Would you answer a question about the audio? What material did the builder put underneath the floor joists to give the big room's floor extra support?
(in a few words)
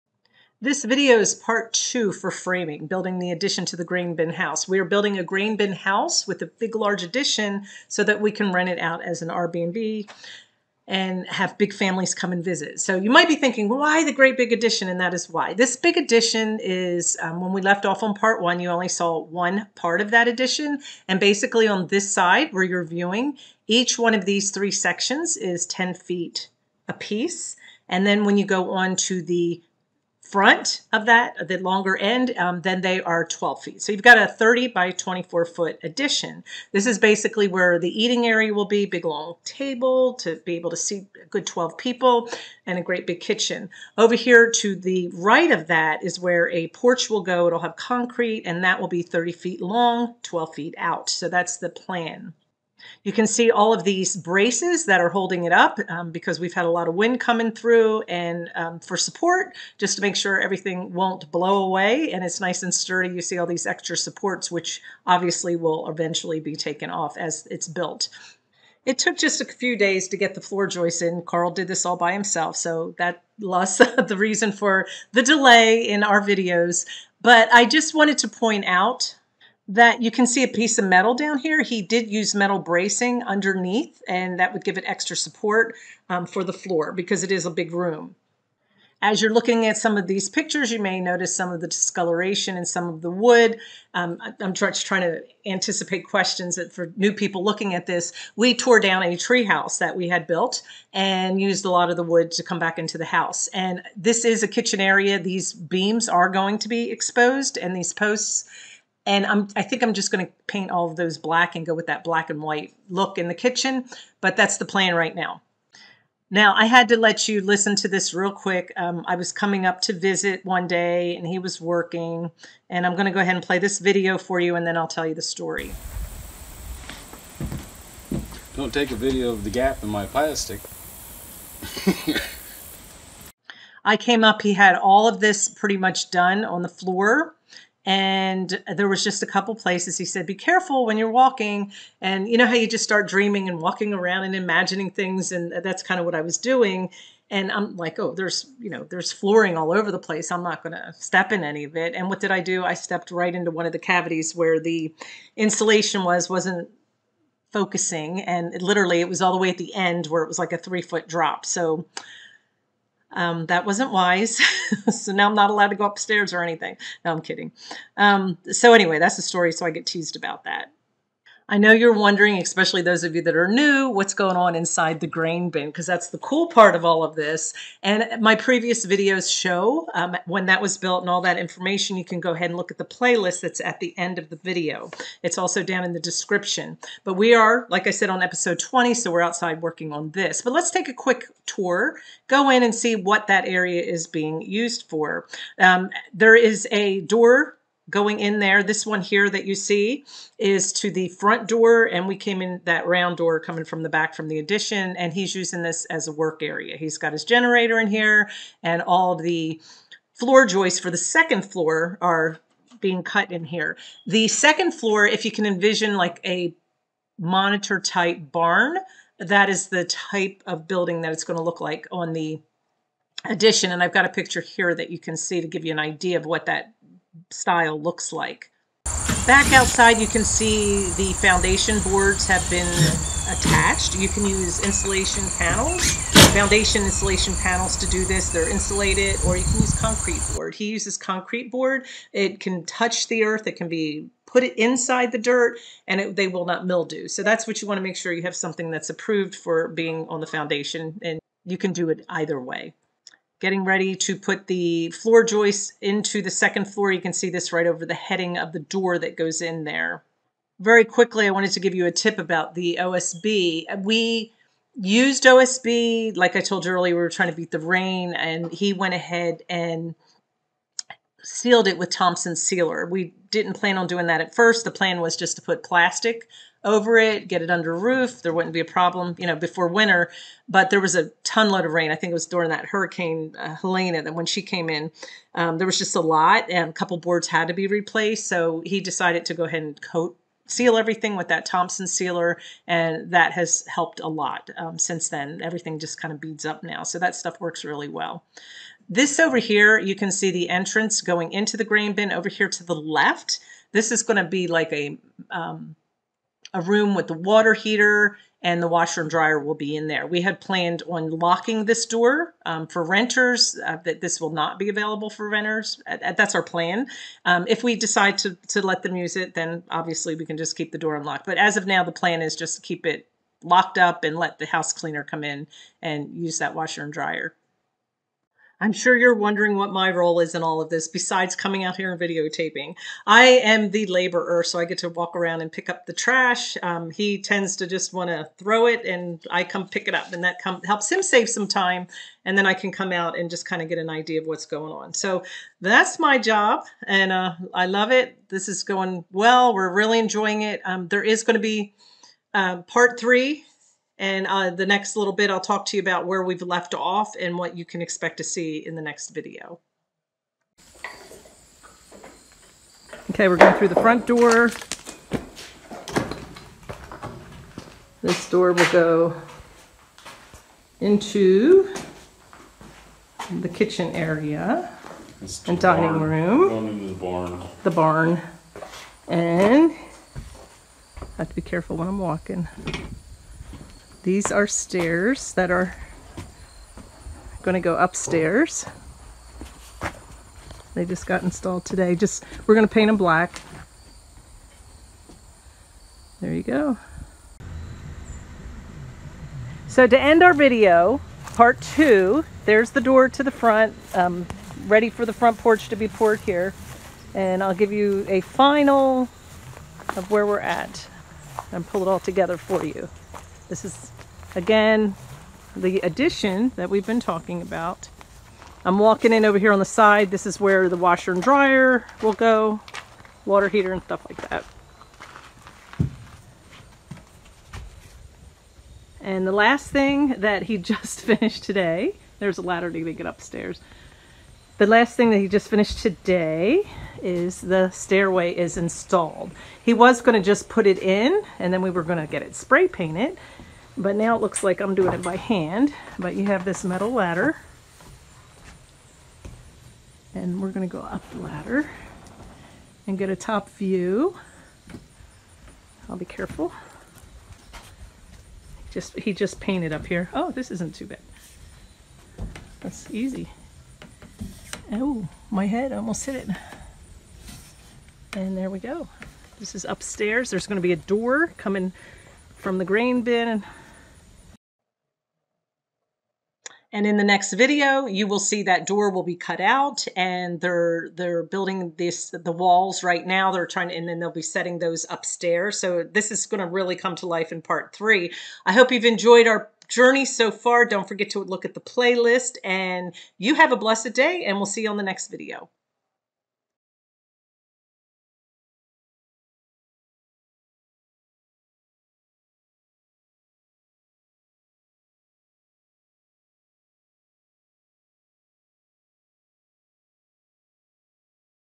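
Metal bracing.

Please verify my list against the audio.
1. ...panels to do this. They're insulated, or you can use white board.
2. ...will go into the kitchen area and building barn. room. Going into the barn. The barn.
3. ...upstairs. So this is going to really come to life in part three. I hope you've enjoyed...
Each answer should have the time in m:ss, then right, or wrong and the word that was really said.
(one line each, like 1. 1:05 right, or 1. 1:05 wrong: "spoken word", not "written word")
1. 3:57 wrong: "concrete", not "white"
2. 6:08 wrong: "dining", not "building"
3. 8:04 right.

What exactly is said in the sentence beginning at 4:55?
Everything just kind of beads up now, so that stuff works really well.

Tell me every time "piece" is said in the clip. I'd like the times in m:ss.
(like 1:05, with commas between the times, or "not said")
0:26, 1:20.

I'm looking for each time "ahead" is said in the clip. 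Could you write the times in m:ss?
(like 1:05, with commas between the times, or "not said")
2:03, 3:02, 4:28, 4:49.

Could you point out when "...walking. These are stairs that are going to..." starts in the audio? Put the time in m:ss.
6:21.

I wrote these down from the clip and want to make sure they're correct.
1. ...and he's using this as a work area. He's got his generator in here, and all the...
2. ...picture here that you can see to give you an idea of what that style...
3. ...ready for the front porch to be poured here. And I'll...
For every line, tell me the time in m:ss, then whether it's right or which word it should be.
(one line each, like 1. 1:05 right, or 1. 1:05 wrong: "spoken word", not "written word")
1. 3:24 right
2. 3:44 right
3. 6:44 right.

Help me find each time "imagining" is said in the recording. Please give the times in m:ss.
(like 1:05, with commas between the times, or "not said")
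2:24.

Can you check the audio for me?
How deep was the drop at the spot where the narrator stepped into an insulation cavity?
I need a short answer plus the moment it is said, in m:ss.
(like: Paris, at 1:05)
3 feet, at 2:40.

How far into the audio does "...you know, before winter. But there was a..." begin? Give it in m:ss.
4:39.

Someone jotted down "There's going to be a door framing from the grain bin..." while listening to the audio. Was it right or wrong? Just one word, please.
wrong.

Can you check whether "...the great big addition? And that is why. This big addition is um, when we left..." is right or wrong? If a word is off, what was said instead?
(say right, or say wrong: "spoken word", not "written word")
right.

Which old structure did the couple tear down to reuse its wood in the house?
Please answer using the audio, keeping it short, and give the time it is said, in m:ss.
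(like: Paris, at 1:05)
A tree house, at 1:39.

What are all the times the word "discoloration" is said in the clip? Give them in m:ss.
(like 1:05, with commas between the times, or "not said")
1:31.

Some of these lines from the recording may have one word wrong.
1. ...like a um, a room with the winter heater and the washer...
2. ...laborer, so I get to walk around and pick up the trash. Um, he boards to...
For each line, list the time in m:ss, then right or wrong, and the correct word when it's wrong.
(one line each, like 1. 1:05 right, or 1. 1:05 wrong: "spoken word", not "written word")
1. 5:04 wrong: "water", not "winter"
2. 5:33 wrong: "tends", not "boards".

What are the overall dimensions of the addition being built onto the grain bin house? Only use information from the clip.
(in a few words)
30 by 24 feet.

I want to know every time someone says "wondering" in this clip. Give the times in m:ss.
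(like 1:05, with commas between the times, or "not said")
2:51, 5:29.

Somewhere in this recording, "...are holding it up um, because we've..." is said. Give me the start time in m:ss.
0:55.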